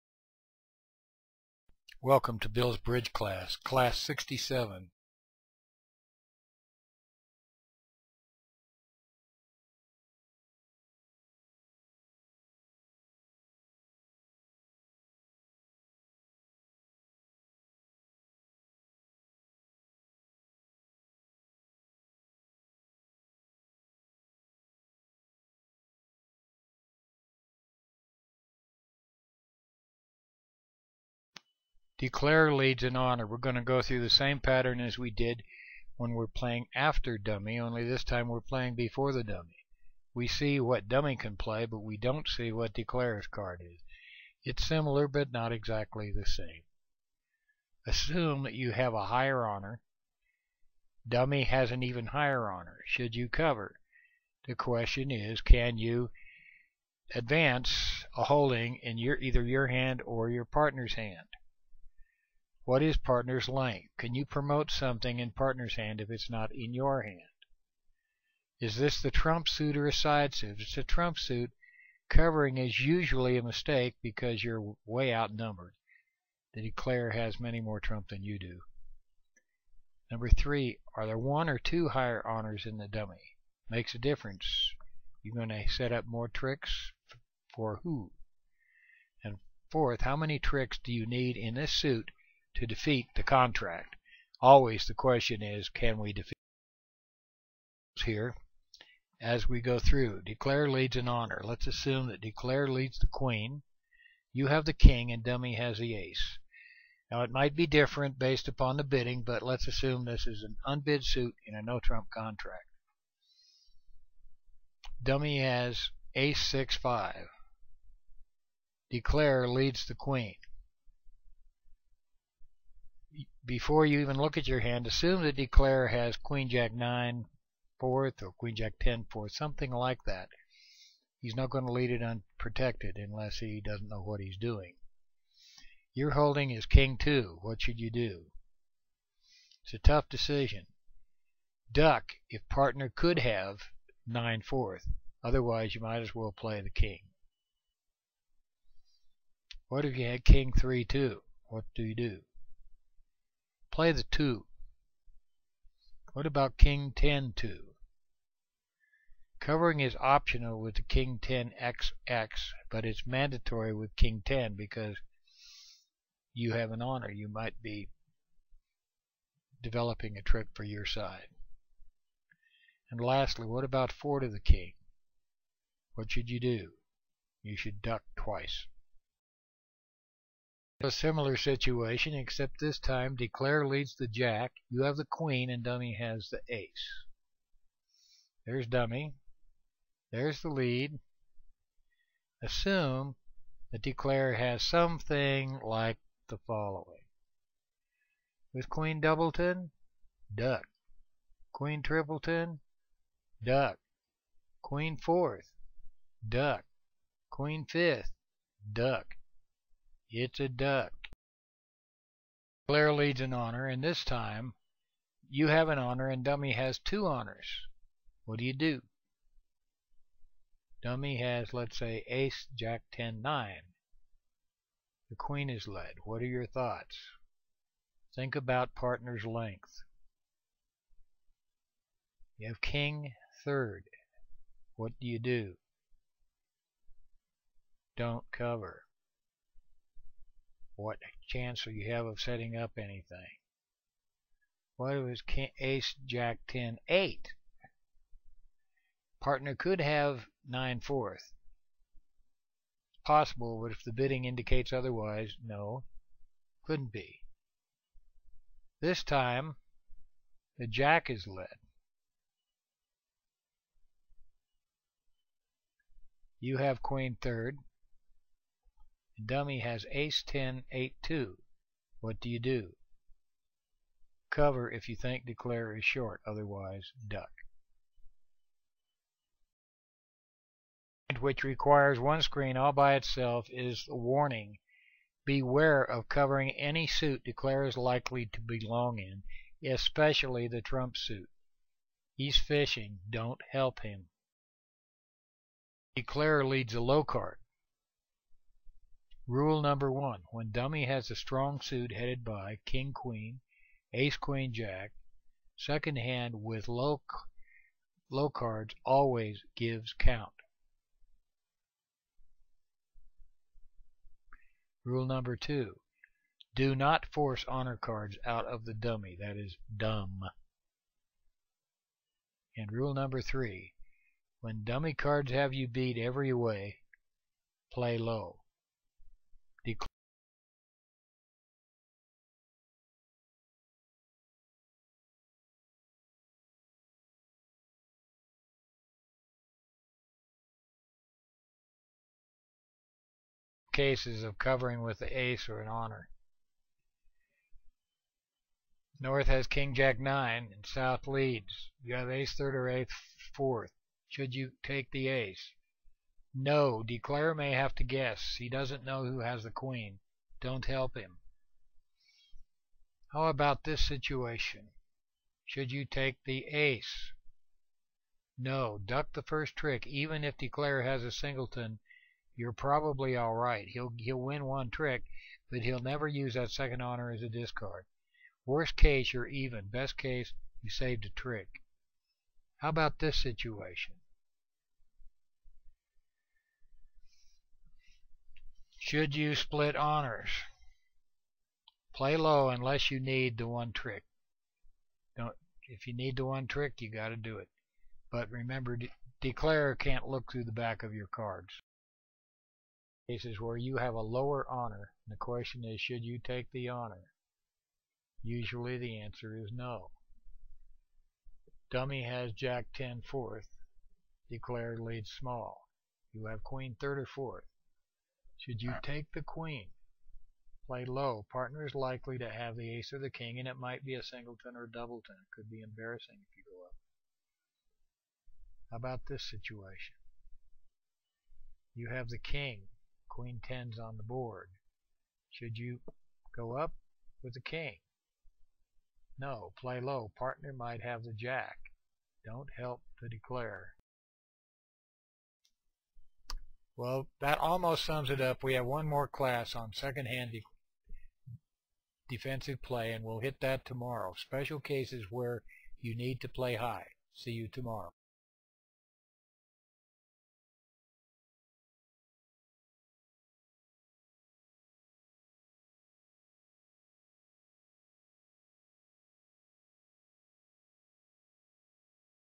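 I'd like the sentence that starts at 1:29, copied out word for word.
And fourth, how many tricks do you need in this suit to defeat the contract.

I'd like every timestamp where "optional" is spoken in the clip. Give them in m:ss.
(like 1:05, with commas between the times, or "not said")
2:39.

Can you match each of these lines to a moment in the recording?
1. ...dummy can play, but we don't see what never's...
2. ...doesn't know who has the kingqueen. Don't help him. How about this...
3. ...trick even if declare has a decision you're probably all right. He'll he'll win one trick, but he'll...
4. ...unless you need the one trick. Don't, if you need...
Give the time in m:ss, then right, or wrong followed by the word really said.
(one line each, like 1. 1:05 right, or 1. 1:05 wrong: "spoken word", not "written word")
1. 0:40 wrong: "declarer", not "never"
2. 5:58 wrong: "queen", not "kingqueen"
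3. 6:09 wrong: "singleton", not "decision"
4. 6:32 right.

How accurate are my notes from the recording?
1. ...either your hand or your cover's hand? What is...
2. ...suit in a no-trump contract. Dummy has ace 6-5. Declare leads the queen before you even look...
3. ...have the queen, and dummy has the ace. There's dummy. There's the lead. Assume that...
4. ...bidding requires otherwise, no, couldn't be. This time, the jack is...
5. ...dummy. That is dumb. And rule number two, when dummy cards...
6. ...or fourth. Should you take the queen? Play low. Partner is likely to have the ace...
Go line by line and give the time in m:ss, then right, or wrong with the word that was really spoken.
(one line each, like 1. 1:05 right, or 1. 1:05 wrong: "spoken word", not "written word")
1. 0:59 wrong: "partner", not "cover"
2. 1:51 right
3. 3:04 right
4. 4:13 wrong: "indicates", not "requires"
5. 5:18 wrong: "three", not "two"
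6. 6:56 right.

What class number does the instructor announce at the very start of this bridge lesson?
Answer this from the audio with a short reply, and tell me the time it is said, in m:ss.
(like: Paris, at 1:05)
67, at 0:03.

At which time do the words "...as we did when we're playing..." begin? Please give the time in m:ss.
0:34.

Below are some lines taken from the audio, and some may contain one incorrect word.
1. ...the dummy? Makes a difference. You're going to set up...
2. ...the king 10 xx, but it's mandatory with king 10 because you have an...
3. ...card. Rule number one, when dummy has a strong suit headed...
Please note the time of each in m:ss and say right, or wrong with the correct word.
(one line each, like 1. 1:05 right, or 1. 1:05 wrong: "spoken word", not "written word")
1. 1:22 right
2. 2:40 right
3. 4:57 right.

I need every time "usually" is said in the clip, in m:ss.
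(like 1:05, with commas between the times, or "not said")
1:12, 6:48.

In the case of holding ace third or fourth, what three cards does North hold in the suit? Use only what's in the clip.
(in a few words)
King jack 9.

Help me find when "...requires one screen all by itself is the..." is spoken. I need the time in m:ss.
4:41.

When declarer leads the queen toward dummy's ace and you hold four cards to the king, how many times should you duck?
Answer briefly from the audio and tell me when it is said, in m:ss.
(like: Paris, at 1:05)
Twice, at 2:57.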